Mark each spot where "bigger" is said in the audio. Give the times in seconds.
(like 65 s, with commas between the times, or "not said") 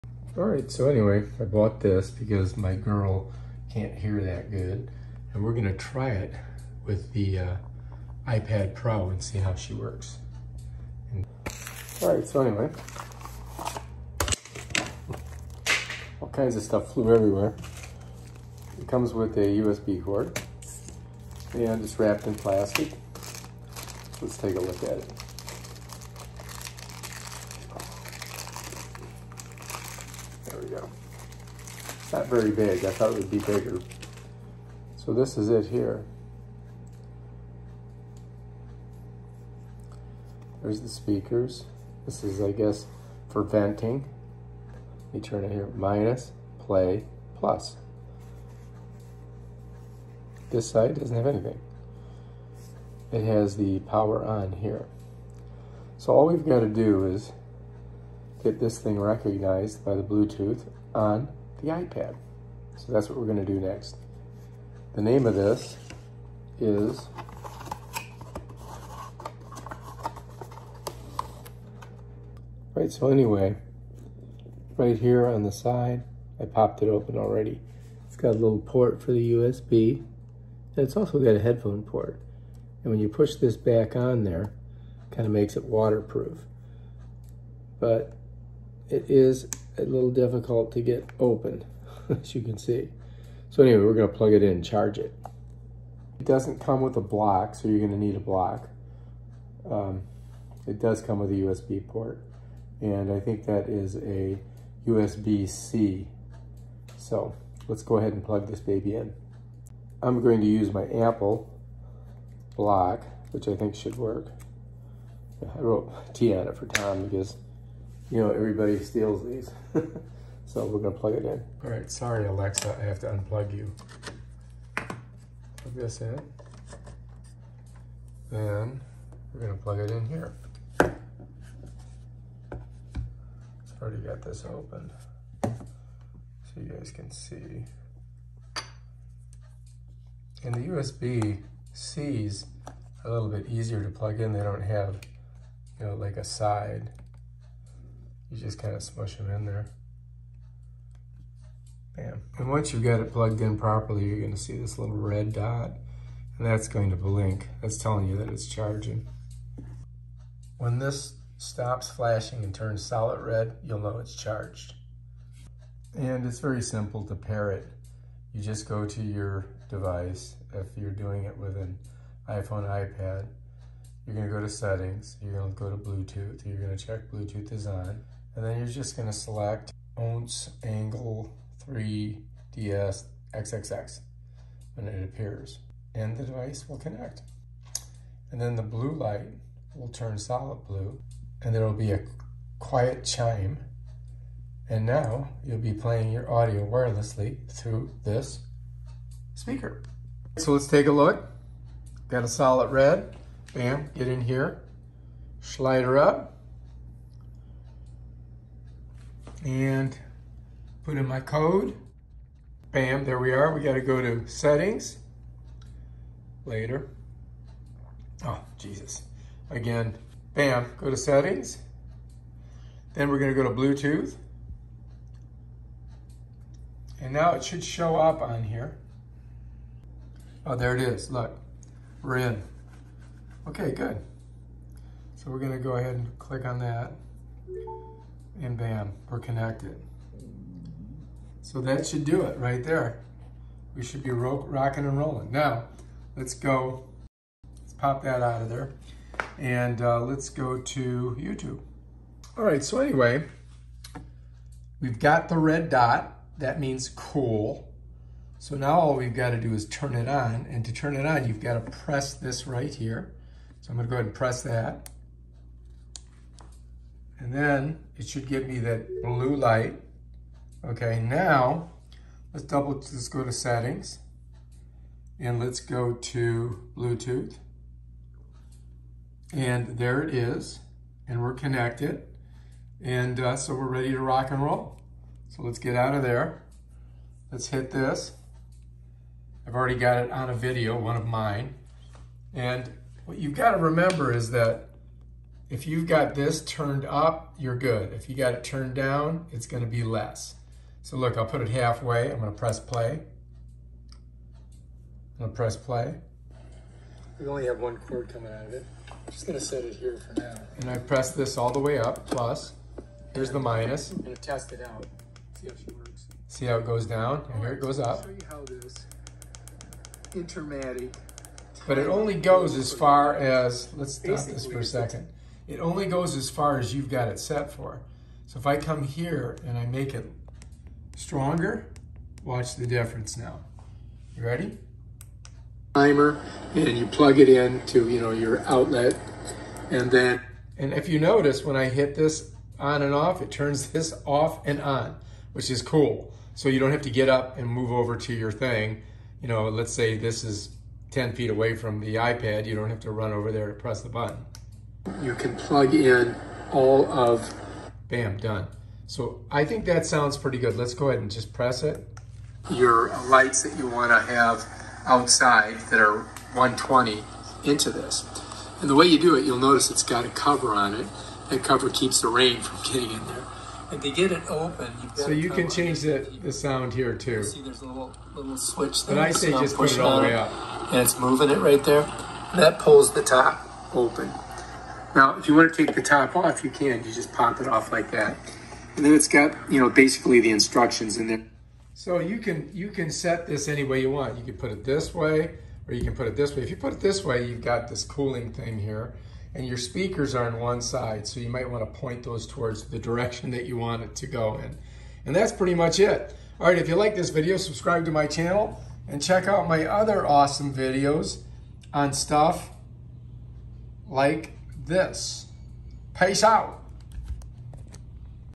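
33 s.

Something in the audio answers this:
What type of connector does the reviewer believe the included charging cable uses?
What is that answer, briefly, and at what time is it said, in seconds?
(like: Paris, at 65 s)
USB-C, at 104 s.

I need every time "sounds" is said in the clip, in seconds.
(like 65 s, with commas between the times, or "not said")
359 s, 376 s.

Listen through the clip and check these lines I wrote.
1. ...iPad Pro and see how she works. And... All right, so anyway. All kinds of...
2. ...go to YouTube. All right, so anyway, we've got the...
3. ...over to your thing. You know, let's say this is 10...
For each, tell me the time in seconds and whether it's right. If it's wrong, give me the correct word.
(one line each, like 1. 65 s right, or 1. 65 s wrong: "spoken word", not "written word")
1. 8 s right
2. 250 s right
3. 347 s right.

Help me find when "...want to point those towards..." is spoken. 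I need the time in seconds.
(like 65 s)
401 s.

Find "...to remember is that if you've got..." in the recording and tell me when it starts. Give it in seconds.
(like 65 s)
293 s.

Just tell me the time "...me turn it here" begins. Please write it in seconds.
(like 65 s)
45 s.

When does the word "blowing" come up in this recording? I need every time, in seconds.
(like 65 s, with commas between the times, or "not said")
not said.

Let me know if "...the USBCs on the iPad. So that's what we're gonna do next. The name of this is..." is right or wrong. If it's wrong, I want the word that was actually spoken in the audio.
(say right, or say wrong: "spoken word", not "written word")
wrong: "Bluetooth", not "USBCs".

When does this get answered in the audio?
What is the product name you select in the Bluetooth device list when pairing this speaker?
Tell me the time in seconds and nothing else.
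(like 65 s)
179 s.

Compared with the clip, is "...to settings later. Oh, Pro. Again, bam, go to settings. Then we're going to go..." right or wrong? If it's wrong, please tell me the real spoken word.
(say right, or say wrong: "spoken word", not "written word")
wrong: "Jesus", not "Pro".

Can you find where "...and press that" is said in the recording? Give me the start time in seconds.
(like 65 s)
264 s.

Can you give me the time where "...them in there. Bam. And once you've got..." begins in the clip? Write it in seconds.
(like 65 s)
149 s.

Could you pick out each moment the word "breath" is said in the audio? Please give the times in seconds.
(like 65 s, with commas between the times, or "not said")
not said.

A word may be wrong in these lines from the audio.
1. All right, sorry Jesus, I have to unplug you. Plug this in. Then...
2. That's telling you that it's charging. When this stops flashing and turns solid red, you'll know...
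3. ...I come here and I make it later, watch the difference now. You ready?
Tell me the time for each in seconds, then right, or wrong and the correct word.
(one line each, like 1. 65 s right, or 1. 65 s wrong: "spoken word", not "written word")
1. 121 s wrong: "Alexa", not "Jesus"
2. 157 s right
3. 328 s wrong: "stronger", not "later".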